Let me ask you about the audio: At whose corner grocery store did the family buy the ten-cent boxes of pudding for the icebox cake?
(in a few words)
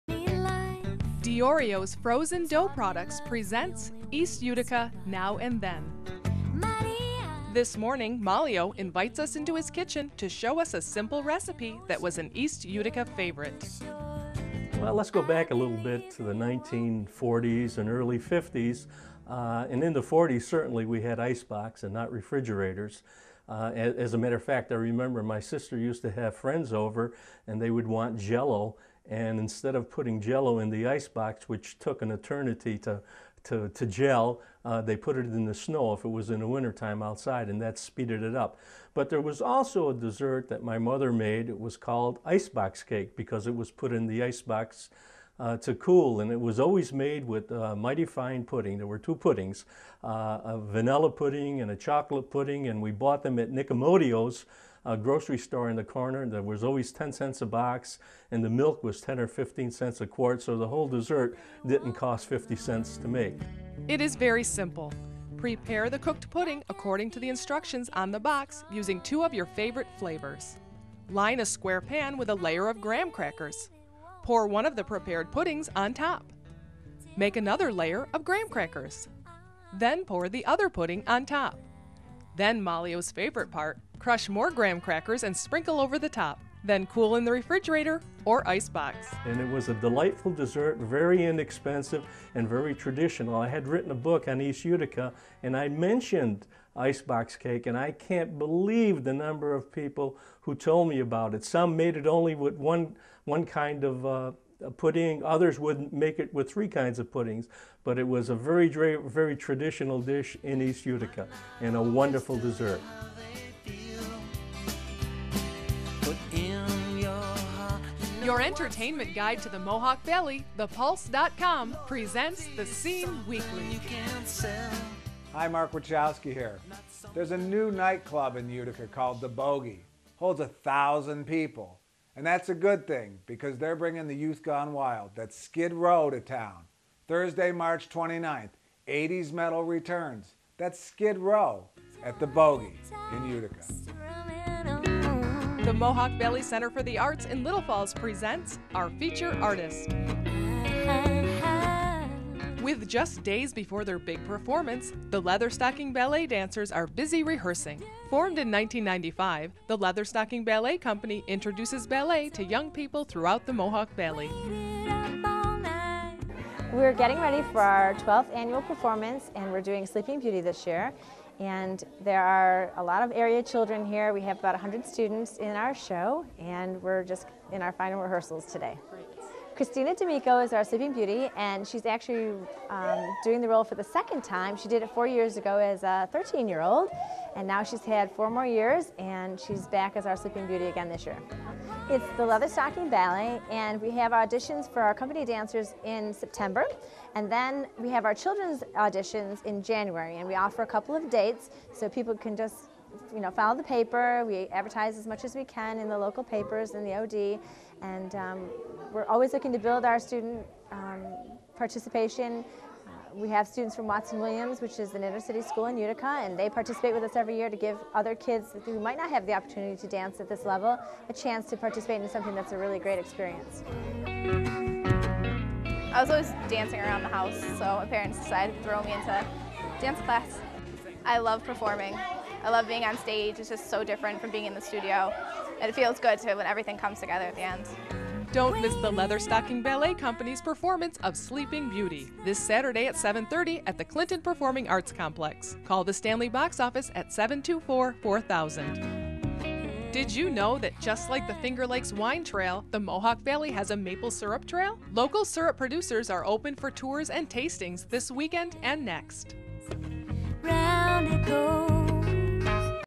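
Nicomodio's.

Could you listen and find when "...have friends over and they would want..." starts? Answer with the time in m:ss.
0:26.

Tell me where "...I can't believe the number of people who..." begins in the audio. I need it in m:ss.
1:37.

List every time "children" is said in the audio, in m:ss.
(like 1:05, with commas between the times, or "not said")
2:53, 3:18.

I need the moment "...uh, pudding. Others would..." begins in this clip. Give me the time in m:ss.
1:44.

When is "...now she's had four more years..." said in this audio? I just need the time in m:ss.
3:07.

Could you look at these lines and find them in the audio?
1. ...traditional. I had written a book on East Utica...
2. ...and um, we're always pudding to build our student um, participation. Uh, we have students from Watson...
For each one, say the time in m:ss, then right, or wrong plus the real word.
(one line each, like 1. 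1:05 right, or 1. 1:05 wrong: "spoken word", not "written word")
1. 1:32 right
2. 3:27 wrong: "looking", not "pudding".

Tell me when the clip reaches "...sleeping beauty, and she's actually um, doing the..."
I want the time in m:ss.
3:00.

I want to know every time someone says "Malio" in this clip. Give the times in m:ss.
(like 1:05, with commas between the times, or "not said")
0:08, 1:22.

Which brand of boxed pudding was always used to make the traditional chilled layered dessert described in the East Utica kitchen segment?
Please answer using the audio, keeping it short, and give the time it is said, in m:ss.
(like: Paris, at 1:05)
My-T-Fine, at 0:47.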